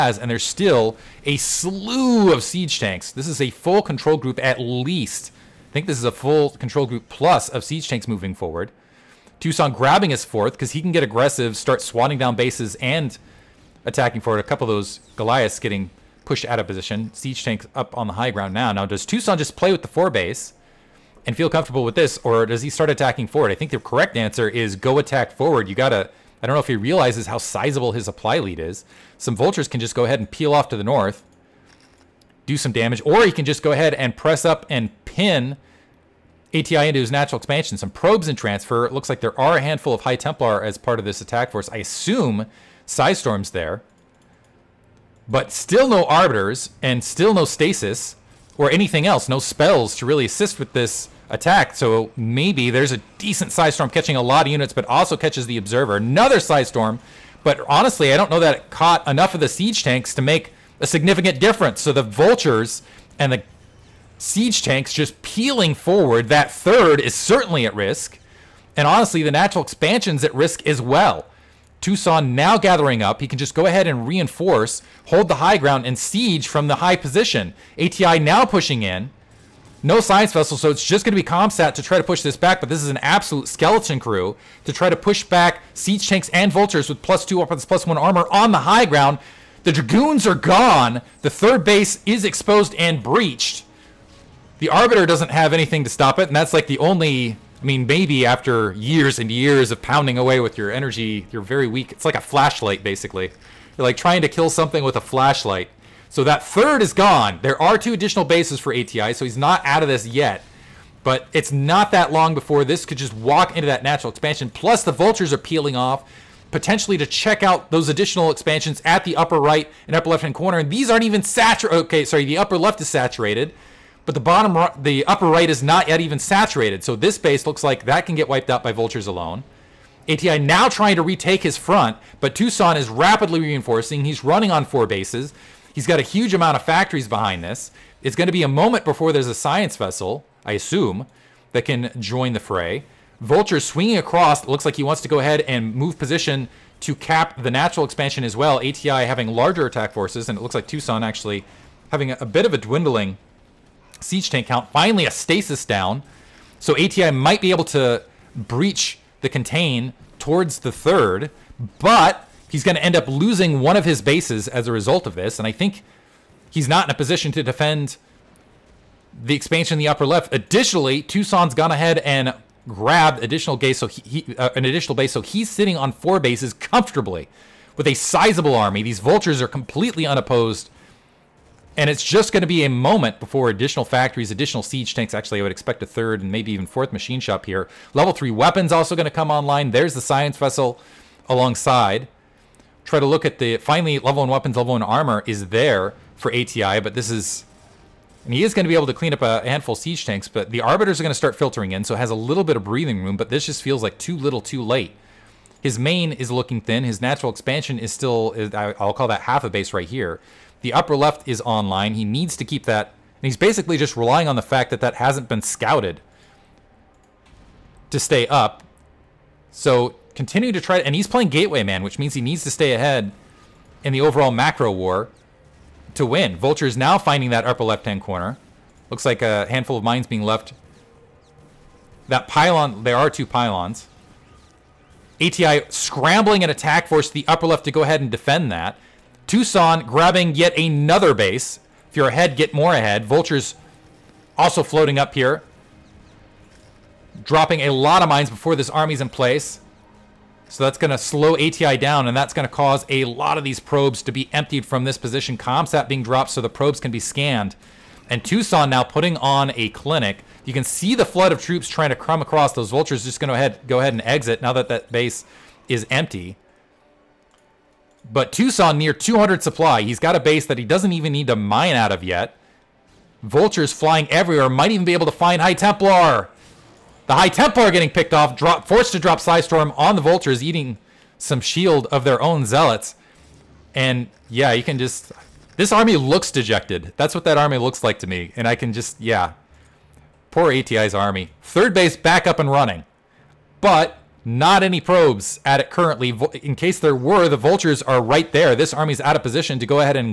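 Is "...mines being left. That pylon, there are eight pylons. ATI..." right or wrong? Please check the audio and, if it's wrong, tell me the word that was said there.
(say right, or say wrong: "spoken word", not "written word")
wrong: "two", not "eight".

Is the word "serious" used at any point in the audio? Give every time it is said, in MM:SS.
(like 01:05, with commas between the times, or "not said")
not said.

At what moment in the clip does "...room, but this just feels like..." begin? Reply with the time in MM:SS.
03:23.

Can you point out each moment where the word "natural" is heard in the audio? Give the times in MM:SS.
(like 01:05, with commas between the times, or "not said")
00:37, 01:09, 01:53, 02:27, 03:26.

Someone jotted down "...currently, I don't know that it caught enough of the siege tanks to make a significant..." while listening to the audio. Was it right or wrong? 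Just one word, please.
wrong.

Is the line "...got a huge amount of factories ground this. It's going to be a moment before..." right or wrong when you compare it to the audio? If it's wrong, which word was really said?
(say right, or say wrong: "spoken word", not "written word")
wrong: "behind", not "ground".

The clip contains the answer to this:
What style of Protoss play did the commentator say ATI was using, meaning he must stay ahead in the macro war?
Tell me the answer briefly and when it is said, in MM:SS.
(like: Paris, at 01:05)
Gateway Man, at 03:41.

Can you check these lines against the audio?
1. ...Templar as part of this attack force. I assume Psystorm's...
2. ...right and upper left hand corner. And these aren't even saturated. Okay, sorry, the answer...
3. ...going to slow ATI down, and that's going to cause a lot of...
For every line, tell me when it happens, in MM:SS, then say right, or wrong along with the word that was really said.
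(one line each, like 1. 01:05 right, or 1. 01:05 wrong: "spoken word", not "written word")
1. 00:40 right
2. 01:59 wrong: "upper", not "answer"
3. 04:10 right.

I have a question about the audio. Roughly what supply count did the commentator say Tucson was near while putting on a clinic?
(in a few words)
200.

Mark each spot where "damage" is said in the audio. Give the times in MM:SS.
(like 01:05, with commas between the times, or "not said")
00:32.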